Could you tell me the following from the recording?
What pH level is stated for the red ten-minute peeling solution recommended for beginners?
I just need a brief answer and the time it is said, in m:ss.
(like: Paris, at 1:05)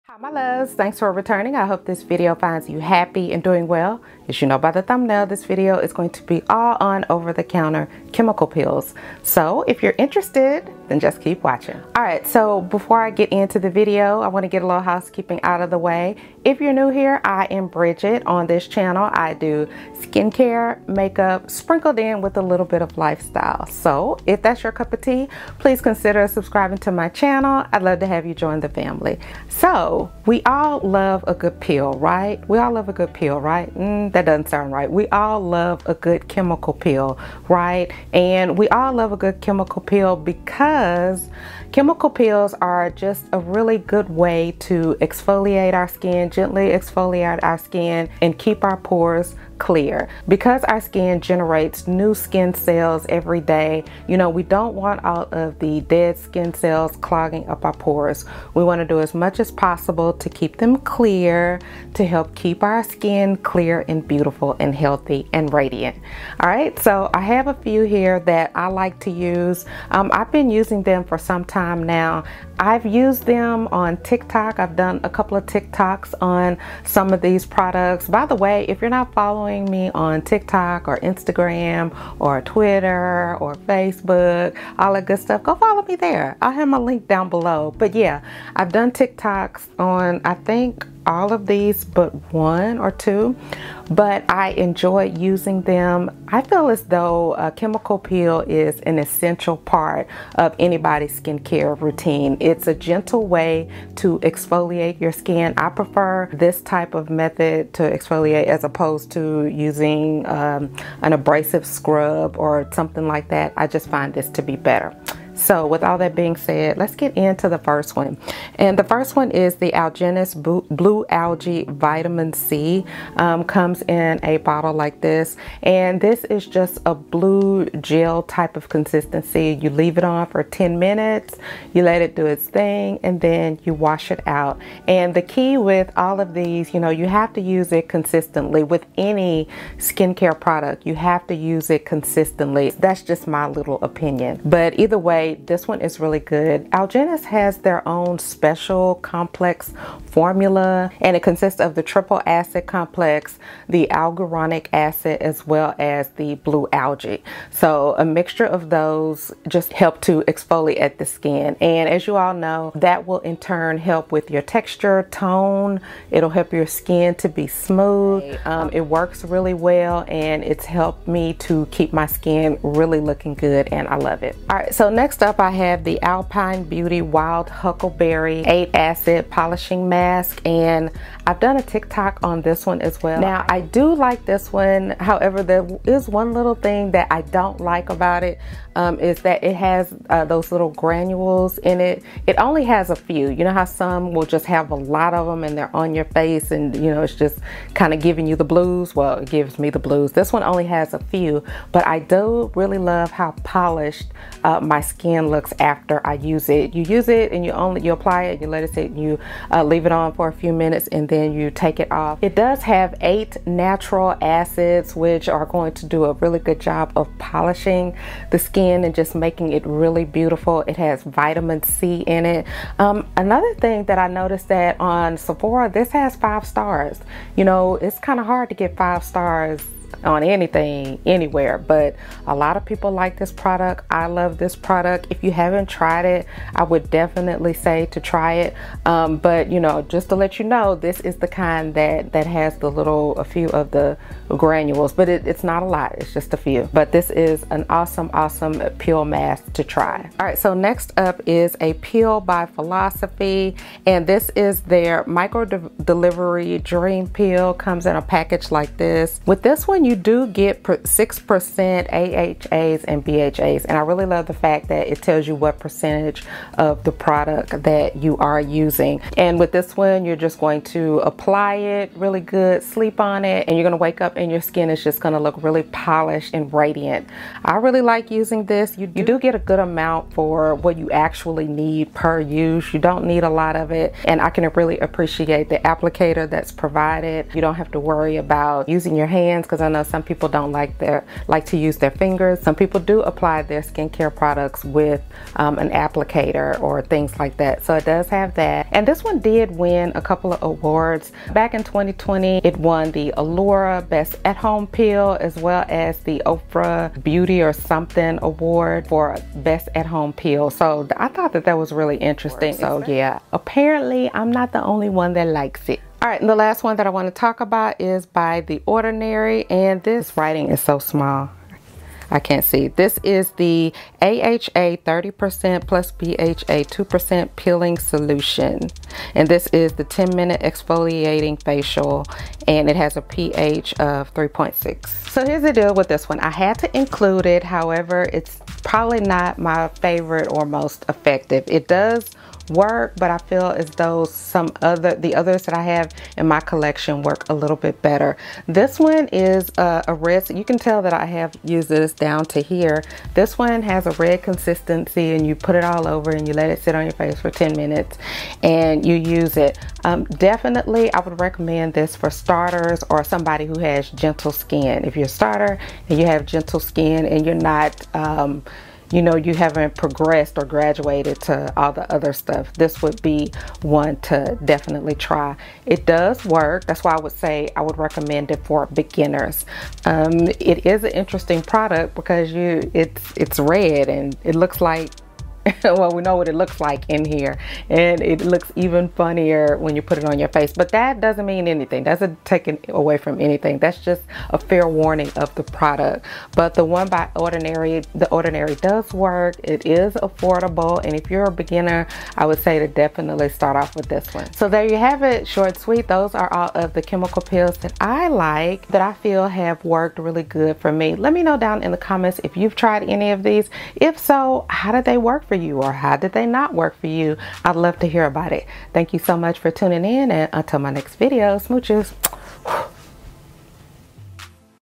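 3.6, at 5:34.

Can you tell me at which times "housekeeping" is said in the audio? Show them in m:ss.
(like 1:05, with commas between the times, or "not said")
0:14.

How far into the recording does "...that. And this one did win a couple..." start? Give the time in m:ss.
4:58.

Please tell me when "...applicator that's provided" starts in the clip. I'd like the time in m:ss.
4:45.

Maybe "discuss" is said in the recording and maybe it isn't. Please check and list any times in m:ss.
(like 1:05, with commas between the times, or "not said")
not said.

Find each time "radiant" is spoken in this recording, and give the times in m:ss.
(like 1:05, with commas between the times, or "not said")
1:05, 4:36.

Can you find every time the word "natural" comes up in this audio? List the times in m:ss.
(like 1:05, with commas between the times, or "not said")
3:33.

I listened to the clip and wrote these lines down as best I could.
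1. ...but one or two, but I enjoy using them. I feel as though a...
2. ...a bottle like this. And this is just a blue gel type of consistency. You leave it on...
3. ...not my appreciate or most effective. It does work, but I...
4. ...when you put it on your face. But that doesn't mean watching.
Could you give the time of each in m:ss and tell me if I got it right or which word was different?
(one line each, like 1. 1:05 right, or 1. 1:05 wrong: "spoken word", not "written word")
1. 1:31 right
2. 2:04 right
3. 5:39 wrong: "favorite", not "appreciate"
4. 6:29 wrong: "anything", not "watching".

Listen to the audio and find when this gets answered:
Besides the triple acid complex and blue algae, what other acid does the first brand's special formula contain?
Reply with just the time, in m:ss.
2:33.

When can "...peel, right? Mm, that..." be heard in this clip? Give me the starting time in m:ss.
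0:33.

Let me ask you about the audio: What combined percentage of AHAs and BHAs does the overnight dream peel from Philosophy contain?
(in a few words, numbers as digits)
6%.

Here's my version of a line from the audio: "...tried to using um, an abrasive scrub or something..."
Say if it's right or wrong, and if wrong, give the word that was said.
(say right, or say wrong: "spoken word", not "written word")
wrong: "opposed", not "tried".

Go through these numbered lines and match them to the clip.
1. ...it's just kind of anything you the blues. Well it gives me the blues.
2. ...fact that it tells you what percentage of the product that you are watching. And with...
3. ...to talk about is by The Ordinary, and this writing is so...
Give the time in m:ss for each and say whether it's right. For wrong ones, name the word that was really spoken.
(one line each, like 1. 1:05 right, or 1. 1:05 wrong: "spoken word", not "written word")
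1. 3:17 wrong: "giving", not "anything"
2. 4:24 wrong: "using", not "watching"
3. 5:17 right.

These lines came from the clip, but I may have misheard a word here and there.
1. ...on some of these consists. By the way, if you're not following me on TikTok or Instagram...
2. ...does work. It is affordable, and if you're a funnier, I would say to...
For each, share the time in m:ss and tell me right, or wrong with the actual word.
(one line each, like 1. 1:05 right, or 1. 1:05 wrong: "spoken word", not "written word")
1. 1:16 wrong: "products", not "consists"
2. 6:38 wrong: "beginner", not "funnier".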